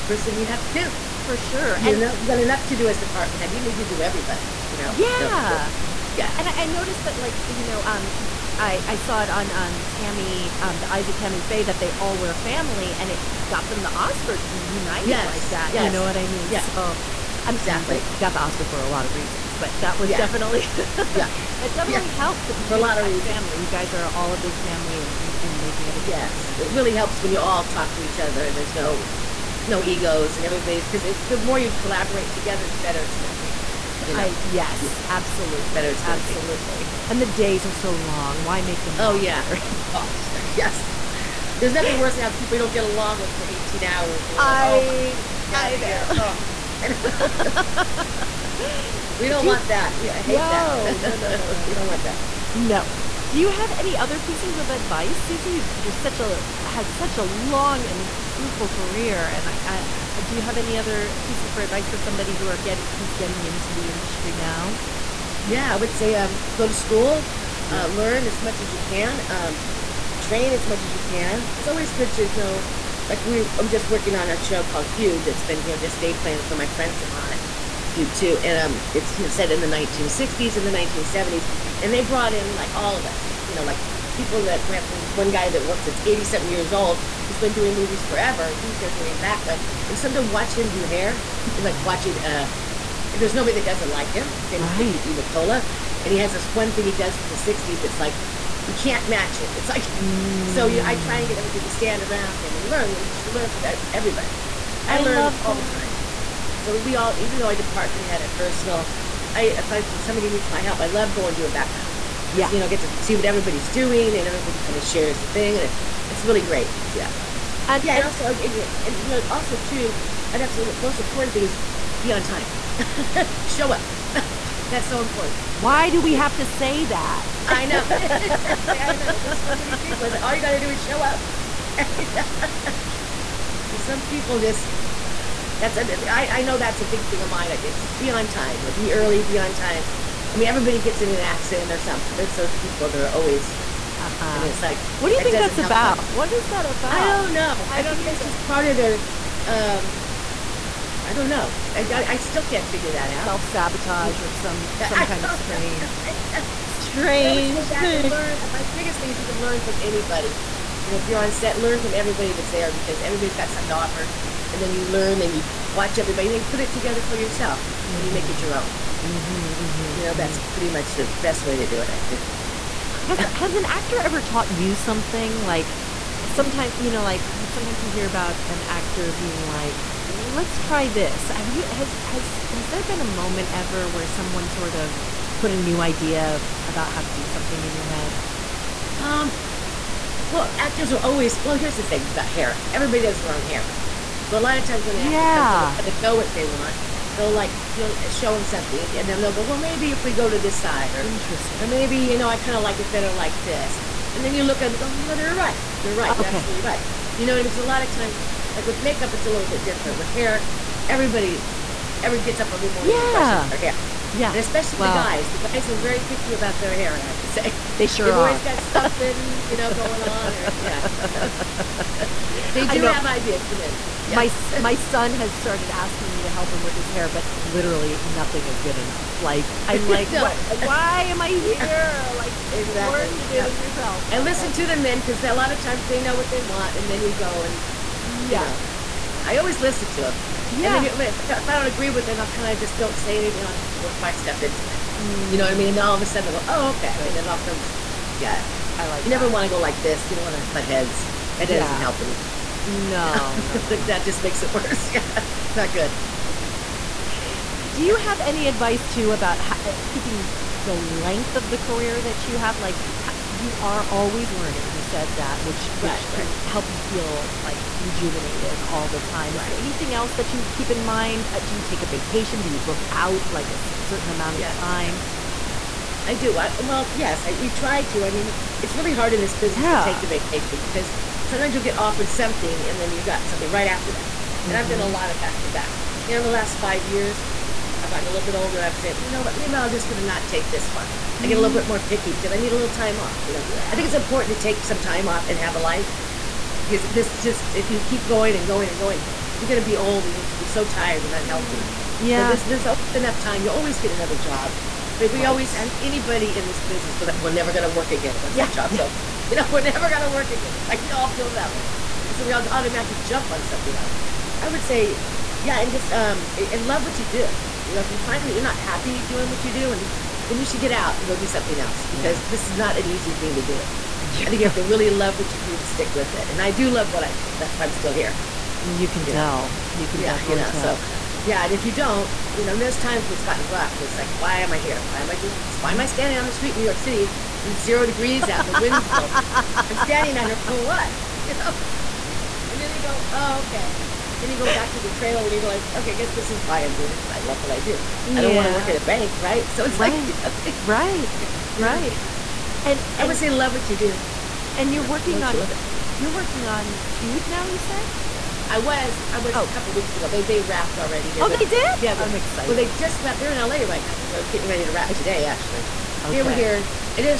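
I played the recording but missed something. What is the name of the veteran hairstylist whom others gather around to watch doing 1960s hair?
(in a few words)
Victor D Nicola.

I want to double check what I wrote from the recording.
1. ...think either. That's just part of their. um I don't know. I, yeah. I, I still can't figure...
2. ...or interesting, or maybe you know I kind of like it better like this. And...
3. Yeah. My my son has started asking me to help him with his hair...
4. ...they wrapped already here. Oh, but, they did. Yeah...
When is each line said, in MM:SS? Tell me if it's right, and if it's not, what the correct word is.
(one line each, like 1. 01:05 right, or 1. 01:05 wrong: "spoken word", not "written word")
1. 02:27 right
2. 03:20 right
3. 03:44 right
4. 06:00 right.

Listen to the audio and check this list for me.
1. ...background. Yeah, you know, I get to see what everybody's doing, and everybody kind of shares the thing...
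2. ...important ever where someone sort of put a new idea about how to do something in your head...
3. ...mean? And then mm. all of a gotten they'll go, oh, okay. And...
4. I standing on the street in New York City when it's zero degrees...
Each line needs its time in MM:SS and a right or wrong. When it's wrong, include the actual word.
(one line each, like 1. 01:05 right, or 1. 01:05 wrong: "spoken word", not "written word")
1. 01:51 right
2. 03:03 wrong: "moment", not "important"
3. 04:05 wrong: "sudden", not "gotten"
4. 05:35 right.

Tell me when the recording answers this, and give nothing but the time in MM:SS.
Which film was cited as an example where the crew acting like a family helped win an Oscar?
00:10.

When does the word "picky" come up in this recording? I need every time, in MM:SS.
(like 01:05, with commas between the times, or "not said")
03:36, 04:51.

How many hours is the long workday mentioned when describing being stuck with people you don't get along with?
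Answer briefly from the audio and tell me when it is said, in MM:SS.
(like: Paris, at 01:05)
18, at 00:43.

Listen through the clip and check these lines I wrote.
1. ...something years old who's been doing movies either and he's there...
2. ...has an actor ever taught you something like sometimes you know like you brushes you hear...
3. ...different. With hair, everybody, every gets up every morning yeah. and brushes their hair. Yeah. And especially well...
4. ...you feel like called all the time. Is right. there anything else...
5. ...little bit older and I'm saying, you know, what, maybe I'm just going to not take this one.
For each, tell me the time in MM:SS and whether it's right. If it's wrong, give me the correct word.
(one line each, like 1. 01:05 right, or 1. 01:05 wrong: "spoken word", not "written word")
1. 01:26 wrong: "forever", not "either"
2. 02:53 wrong: "sometimes", not "brushes"
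3. 03:29 right
4. 04:26 wrong: "rejuvenated", not "called"
5. 04:48 right.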